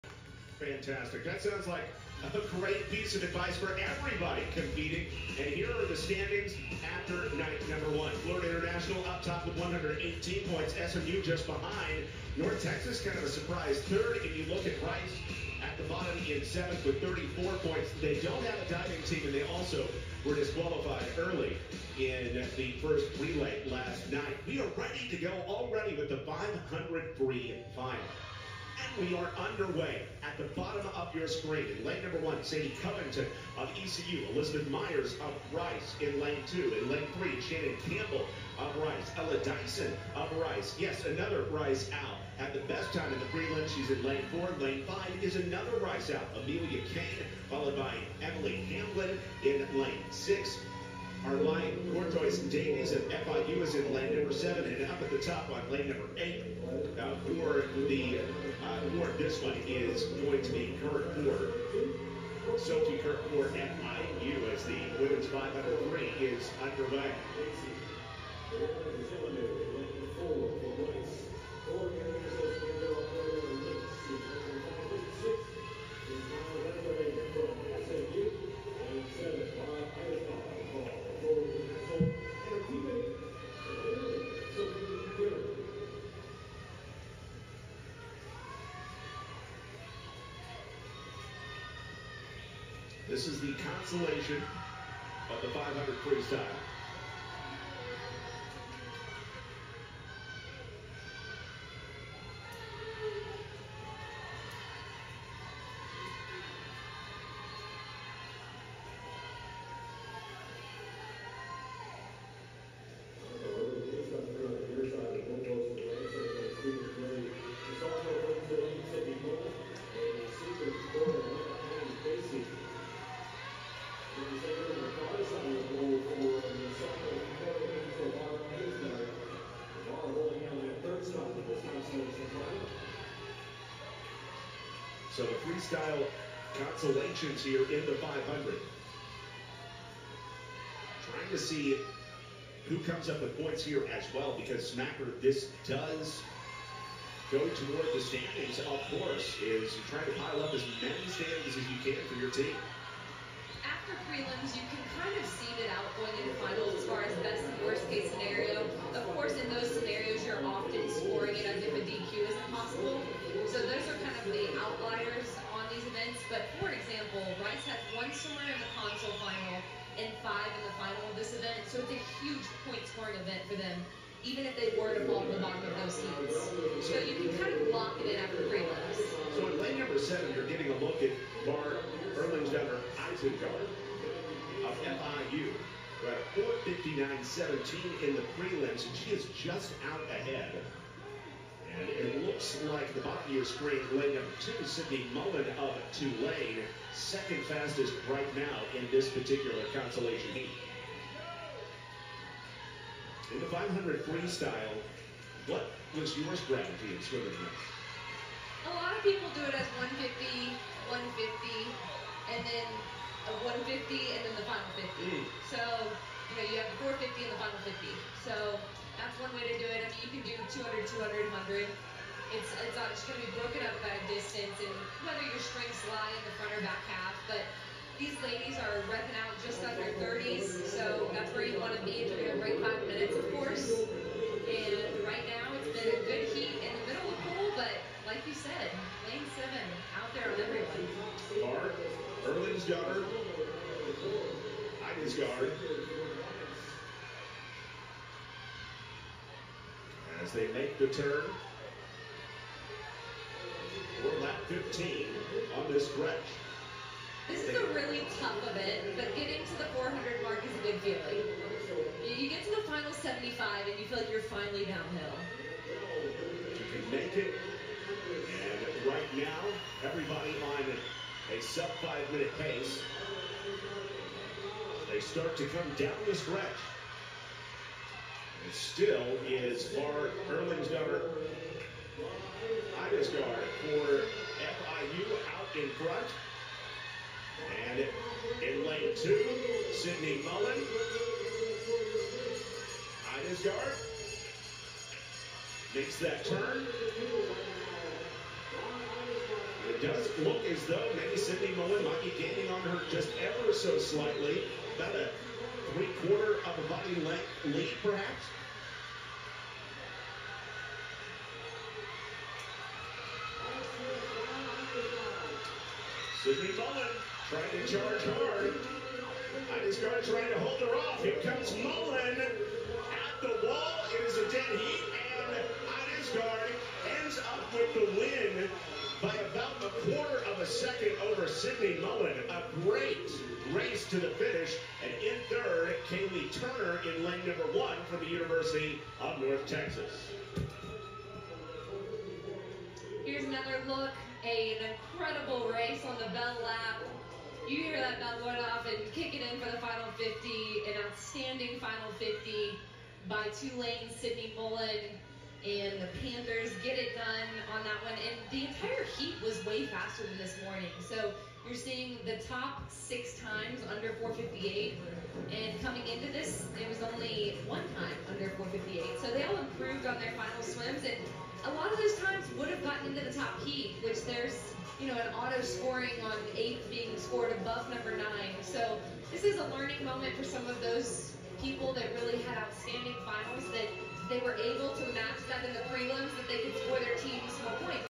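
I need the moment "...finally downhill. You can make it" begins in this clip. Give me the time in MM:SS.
04:24.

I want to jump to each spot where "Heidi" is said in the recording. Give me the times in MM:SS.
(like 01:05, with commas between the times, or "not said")
05:19, 05:25.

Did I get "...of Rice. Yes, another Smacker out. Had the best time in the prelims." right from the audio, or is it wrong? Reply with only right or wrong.
wrong.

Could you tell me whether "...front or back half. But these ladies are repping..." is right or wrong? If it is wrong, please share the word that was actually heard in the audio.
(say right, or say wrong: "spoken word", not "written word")
right.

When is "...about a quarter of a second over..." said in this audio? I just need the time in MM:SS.
05:29.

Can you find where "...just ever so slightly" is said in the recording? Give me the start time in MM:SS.
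05:02.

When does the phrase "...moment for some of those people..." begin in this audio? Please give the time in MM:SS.
06:19.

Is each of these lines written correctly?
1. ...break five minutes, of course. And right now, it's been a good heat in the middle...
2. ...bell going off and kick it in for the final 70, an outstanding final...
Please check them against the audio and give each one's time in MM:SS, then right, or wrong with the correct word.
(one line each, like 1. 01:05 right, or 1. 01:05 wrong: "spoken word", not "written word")
1. 03:52 right
2. 05:47 wrong: "50", not "70".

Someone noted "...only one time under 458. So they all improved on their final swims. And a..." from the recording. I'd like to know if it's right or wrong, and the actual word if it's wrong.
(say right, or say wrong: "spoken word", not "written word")
right.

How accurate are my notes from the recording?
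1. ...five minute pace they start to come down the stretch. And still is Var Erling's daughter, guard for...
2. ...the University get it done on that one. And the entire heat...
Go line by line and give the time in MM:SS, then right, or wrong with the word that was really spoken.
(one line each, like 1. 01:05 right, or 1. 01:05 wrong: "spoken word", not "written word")
1. 04:31 right
2. 05:55 wrong: "Panthers", not "University".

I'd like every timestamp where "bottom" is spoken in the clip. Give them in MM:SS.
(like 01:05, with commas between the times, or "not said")
00:15, 00:30, 02:55.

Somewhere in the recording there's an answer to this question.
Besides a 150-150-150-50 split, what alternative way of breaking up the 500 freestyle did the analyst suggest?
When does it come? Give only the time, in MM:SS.
03:40.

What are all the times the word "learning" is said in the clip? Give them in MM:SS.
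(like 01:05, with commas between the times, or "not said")
06:19.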